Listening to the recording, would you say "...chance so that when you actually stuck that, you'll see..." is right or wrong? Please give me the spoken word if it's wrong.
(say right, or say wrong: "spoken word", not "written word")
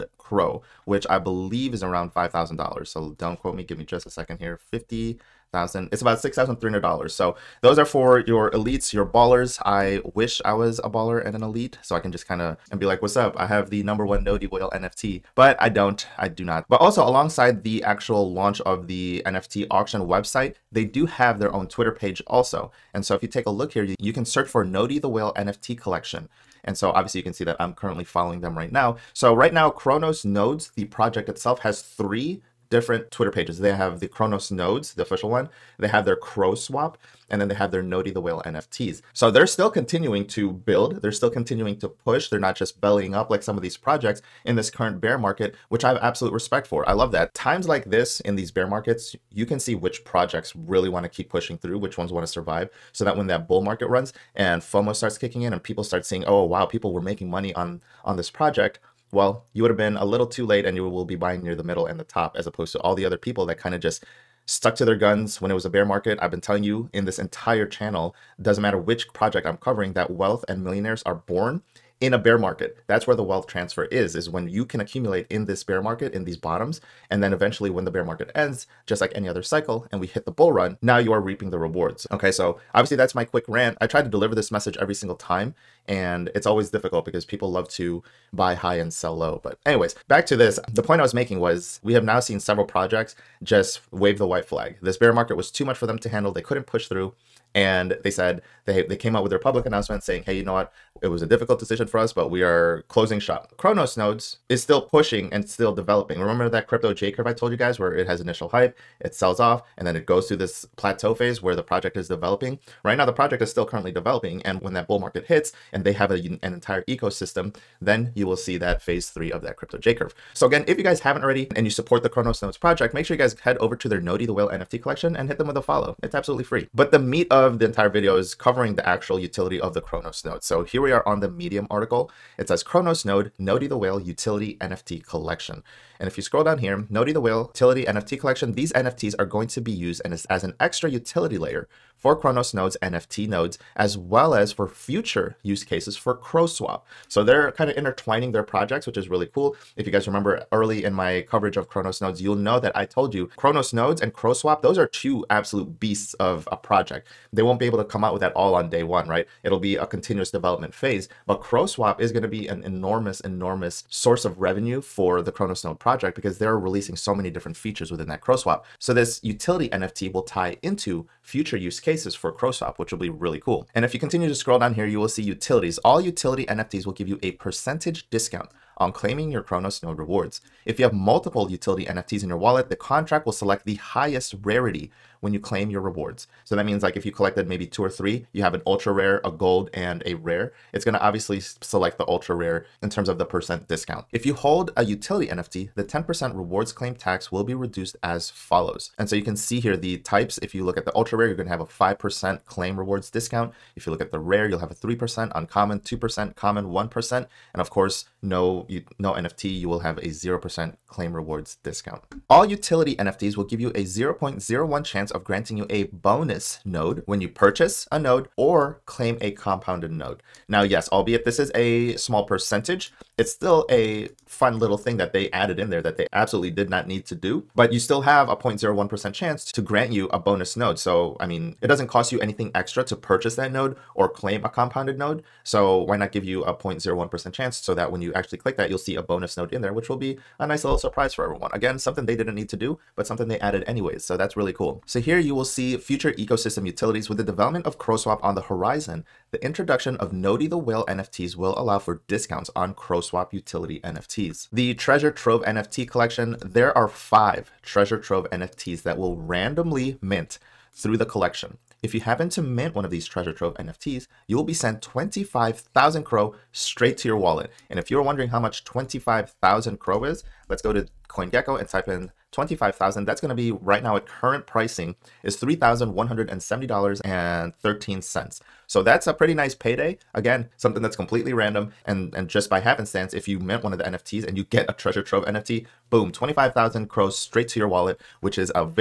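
wrong: "click", not "stuck".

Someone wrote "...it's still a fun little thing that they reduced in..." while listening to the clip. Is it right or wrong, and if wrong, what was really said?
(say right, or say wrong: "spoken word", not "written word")
wrong: "added", not "reduced".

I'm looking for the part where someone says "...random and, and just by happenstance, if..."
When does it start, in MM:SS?
04:41.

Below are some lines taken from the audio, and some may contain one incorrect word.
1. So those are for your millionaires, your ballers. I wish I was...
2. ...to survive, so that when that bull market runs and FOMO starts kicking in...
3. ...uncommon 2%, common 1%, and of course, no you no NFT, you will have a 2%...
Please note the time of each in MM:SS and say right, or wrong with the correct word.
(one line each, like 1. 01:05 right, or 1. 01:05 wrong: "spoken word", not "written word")
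1. 00:07 wrong: "elites", not "millionaires"
2. 00:52 right
3. 03:25 wrong: "0", not "2".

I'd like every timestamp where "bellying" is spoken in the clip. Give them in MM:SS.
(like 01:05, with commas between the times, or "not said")
00:42.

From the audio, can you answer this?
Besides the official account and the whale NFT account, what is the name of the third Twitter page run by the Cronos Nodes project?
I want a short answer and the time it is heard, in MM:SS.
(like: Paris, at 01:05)
Cro Swap, at 00:36.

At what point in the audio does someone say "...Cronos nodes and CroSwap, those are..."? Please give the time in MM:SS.
02:33.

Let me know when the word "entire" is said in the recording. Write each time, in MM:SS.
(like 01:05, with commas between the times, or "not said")
01:07, 01:56, 02:07.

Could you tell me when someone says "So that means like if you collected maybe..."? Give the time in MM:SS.
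03:06.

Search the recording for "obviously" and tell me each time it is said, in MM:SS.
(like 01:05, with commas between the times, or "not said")
00:26, 01:22, 03:10.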